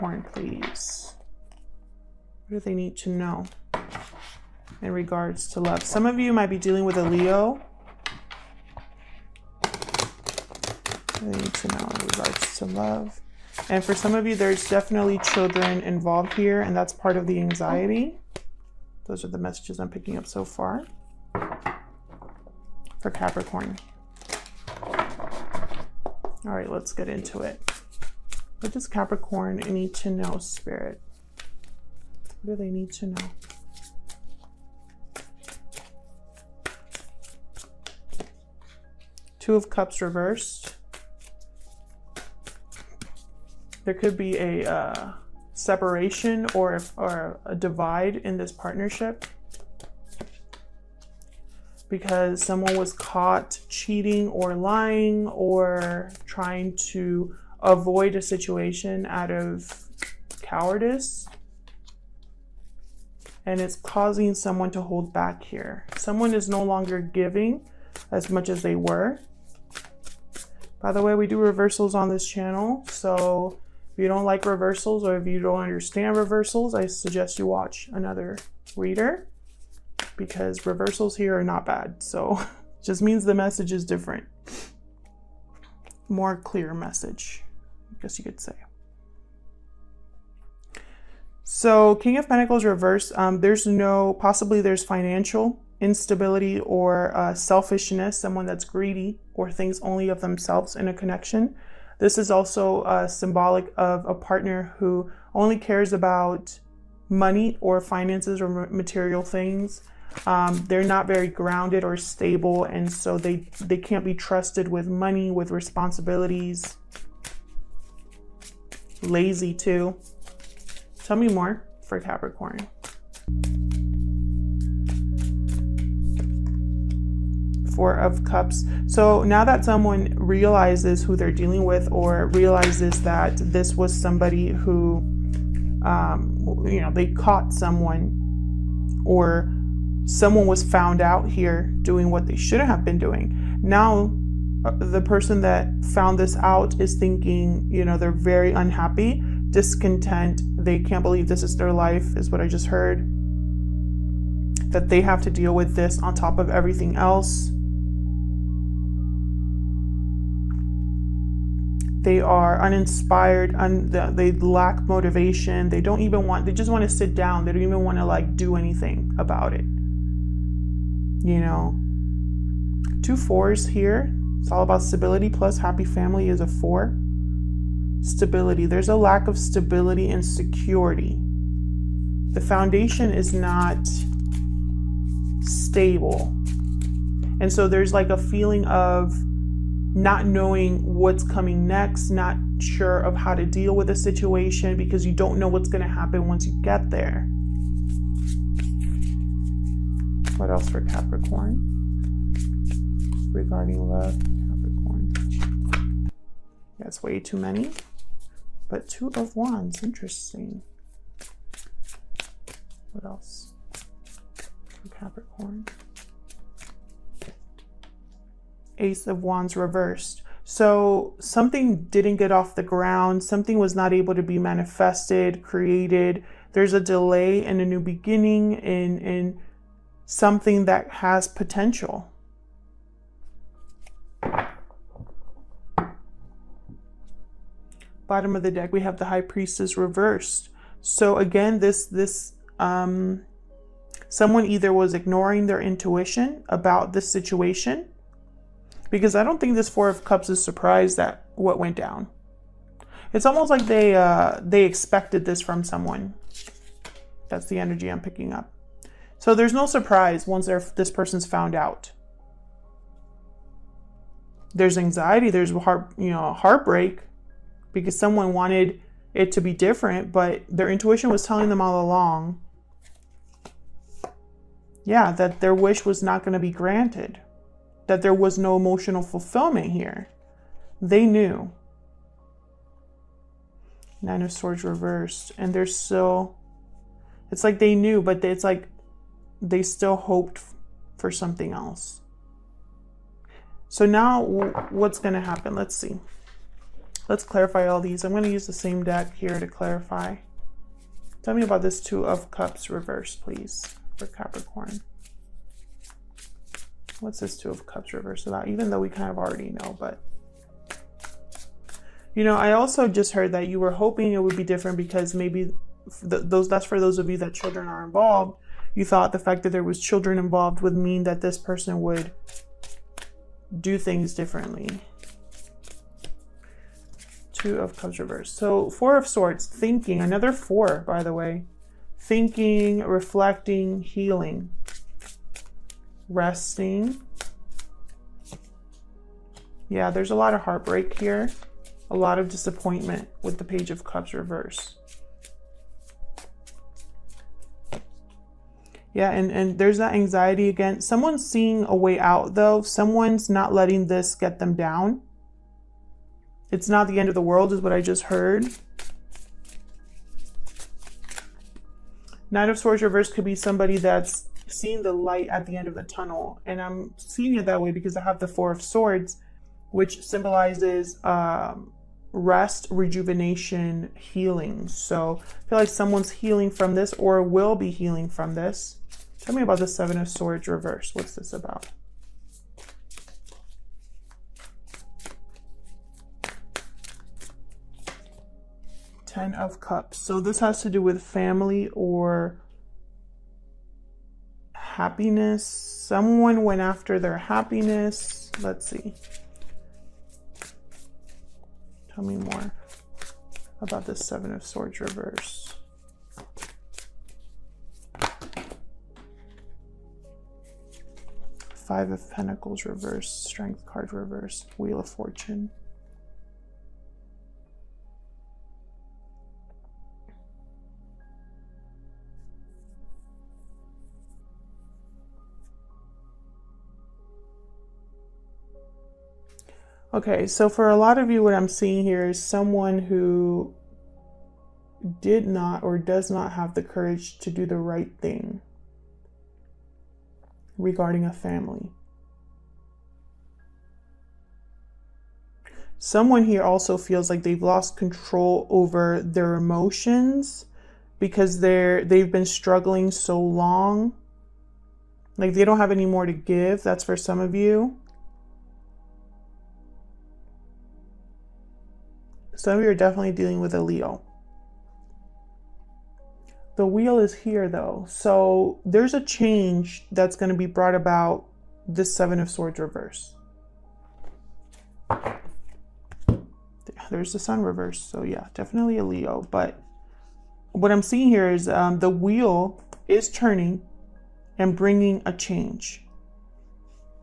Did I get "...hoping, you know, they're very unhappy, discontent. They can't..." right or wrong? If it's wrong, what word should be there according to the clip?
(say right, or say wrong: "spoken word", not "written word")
wrong: "thinking", not "hoping".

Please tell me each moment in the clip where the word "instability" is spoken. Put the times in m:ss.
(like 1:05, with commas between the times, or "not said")
1:35.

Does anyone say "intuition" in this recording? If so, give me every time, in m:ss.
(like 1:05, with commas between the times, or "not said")
4:05, 4:30.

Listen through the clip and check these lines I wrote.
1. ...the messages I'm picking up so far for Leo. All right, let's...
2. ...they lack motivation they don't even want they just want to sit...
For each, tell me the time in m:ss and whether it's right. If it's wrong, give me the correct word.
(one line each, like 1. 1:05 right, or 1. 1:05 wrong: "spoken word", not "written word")
1. 0:19 wrong: "Capricorn", not "Leo"
2. 2:44 right.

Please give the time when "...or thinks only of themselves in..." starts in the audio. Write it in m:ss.
1:39.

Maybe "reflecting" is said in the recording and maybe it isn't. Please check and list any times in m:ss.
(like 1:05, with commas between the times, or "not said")
5:32.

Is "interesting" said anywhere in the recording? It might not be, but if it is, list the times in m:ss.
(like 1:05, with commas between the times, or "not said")
3:29.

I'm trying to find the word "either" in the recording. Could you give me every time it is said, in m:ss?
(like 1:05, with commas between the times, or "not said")
4:04.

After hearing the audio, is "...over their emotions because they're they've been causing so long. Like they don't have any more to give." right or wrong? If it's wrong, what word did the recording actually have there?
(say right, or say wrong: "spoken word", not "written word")
wrong: "struggling", not "causing".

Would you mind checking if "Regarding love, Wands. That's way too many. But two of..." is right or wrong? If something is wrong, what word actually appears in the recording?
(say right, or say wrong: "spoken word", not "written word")
wrong: "Capricorn", not "Wands".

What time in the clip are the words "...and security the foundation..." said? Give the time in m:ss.
3:00.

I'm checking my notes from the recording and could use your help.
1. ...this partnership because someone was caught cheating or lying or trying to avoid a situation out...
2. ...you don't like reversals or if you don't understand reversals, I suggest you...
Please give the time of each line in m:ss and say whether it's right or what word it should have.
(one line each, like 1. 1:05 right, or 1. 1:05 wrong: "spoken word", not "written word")
1. 0:48 right
2. 1:14 right.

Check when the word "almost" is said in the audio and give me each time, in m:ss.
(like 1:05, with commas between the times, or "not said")
4:13.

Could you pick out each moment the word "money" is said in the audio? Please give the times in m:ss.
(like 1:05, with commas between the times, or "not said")
1:47, 1:54.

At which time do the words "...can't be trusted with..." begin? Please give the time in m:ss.
1:53.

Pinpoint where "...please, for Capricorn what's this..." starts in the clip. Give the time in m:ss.
5:03.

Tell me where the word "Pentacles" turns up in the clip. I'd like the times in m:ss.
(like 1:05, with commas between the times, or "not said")
1:32, 6:52.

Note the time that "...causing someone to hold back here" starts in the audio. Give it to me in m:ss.
1:03.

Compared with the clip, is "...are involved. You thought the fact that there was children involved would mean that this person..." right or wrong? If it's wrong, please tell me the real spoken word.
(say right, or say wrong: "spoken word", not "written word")
right.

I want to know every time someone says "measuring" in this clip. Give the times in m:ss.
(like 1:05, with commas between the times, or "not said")
not said.